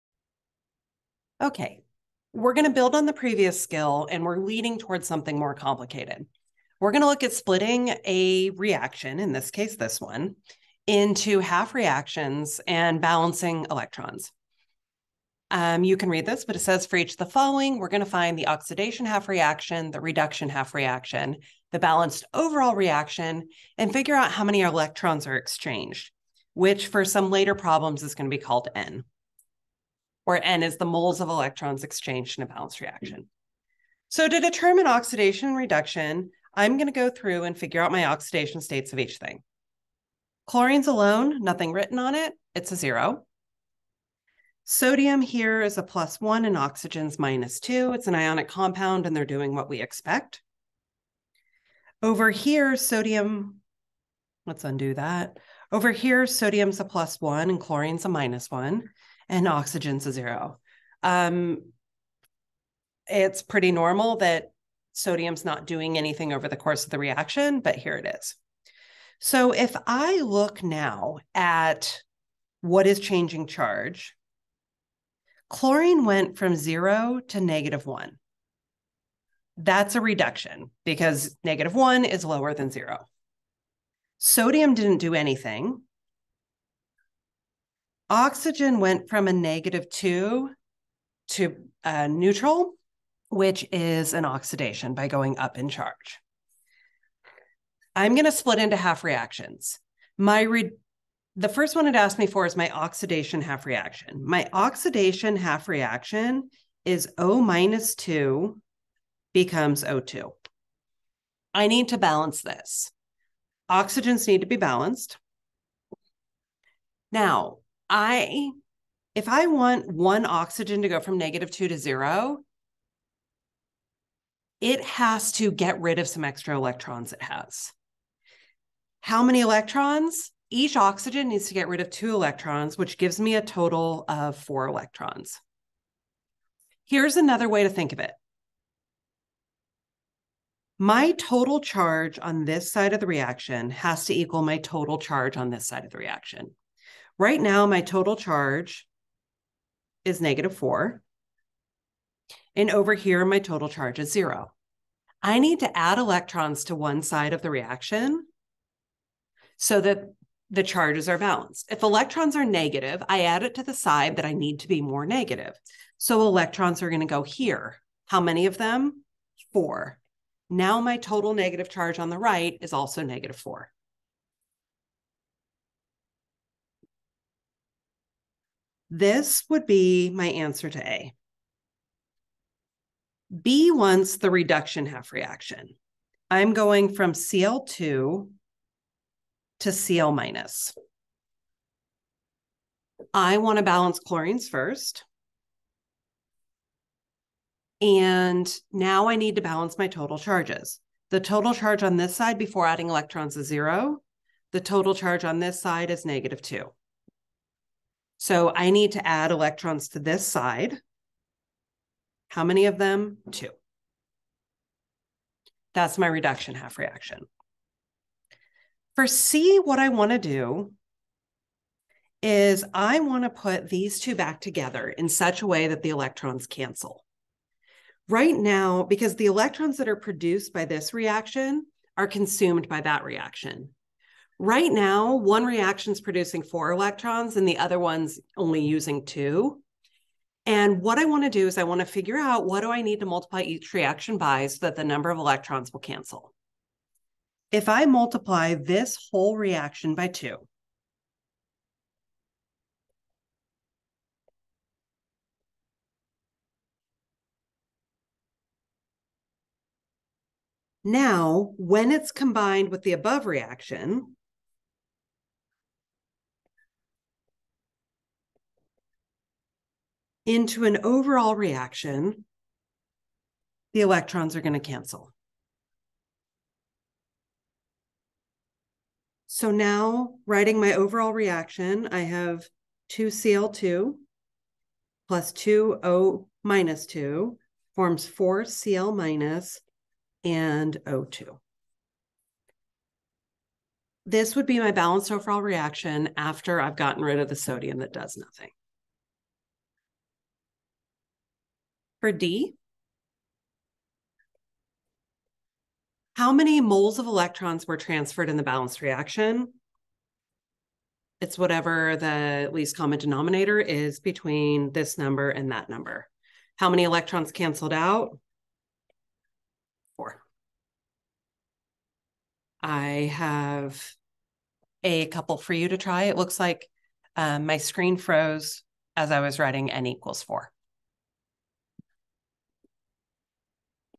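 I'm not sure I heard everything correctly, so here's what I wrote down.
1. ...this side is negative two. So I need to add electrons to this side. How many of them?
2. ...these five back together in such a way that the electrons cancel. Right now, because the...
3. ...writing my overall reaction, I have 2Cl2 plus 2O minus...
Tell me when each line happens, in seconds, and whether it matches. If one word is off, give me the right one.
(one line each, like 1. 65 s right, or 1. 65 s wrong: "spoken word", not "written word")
1. 205 s right
2. 223 s wrong: "two", not "five"
3. 280 s right.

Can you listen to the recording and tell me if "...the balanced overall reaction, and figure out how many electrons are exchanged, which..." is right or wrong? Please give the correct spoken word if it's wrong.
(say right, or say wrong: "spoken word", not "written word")
right.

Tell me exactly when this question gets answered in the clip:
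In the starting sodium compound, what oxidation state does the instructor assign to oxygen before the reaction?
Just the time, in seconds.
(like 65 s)
46 s.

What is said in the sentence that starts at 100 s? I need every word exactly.
My re- the first one it asked me for is my oxidation half reaction.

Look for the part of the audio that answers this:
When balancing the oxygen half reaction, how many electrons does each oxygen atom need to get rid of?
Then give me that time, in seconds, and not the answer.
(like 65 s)
131 s.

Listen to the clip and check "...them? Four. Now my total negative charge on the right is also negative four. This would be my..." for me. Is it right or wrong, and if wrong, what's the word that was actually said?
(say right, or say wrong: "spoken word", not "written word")
right.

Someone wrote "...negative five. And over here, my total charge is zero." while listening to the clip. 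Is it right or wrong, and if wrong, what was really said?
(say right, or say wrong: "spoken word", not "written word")
wrong: "four", not "five".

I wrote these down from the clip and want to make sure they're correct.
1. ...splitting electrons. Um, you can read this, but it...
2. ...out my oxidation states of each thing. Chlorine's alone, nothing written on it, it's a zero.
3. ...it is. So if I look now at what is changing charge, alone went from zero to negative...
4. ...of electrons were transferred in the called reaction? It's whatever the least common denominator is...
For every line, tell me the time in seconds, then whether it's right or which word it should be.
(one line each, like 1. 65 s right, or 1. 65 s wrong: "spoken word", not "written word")
1. 13 s wrong: "balancing", not "splitting"
2. 37 s right
3. 67 s wrong: "chlorine", not "alone"
4. 306 s wrong: "balanced", not "called".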